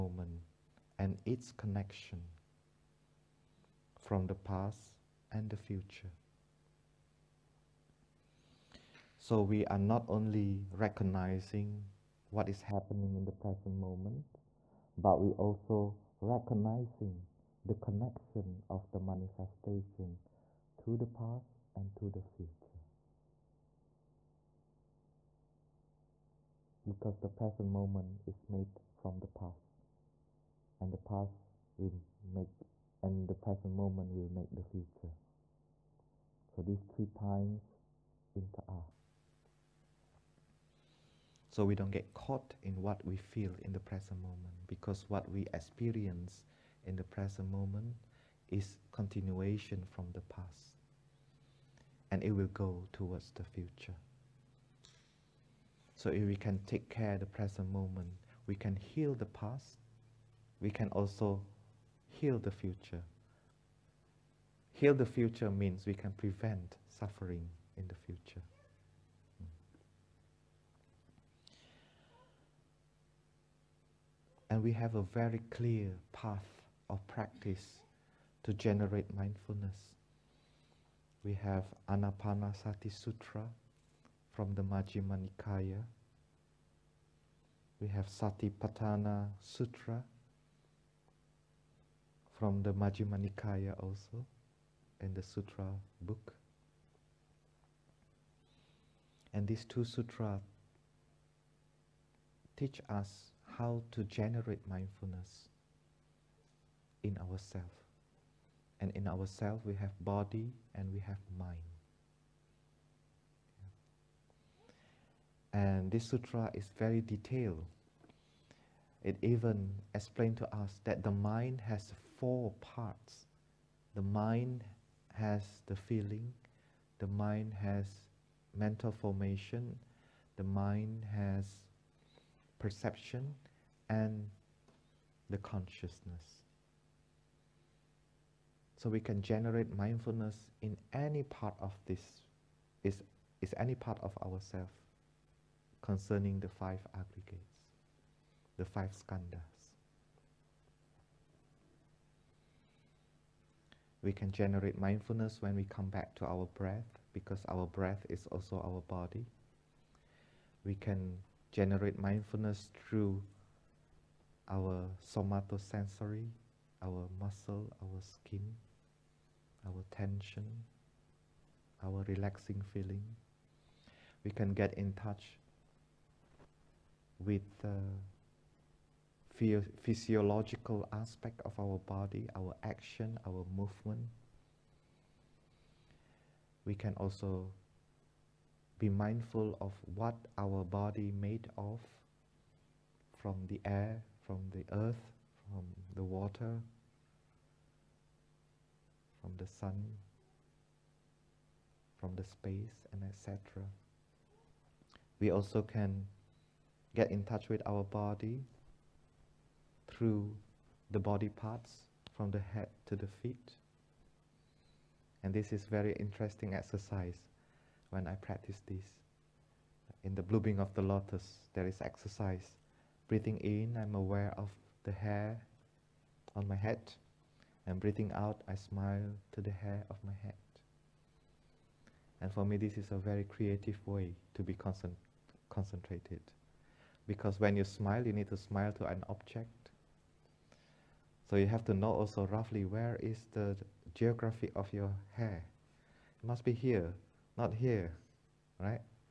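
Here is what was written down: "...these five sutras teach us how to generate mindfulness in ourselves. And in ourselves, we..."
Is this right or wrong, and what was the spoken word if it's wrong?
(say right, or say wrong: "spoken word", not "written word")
wrong: "two", not "five".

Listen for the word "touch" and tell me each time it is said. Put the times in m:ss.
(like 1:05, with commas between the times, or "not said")
2:54, 3:27.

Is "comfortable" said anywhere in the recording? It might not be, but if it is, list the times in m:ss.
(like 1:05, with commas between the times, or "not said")
not said.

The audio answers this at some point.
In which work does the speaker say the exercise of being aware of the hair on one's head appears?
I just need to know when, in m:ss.
3:40.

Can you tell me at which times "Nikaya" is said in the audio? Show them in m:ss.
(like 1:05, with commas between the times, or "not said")
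1:25, 1:33.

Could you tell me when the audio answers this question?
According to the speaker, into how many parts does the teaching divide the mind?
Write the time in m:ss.
2:02.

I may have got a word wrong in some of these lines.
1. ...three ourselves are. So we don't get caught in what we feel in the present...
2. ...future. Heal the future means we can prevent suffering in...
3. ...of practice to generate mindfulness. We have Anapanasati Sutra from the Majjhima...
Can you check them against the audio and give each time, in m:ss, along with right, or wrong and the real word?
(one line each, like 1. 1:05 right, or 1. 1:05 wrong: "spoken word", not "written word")
1. 0:36 wrong: "times", not "ourselves"
2. 1:02 right
3. 1:16 right.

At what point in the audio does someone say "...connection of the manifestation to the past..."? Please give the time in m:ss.
0:17.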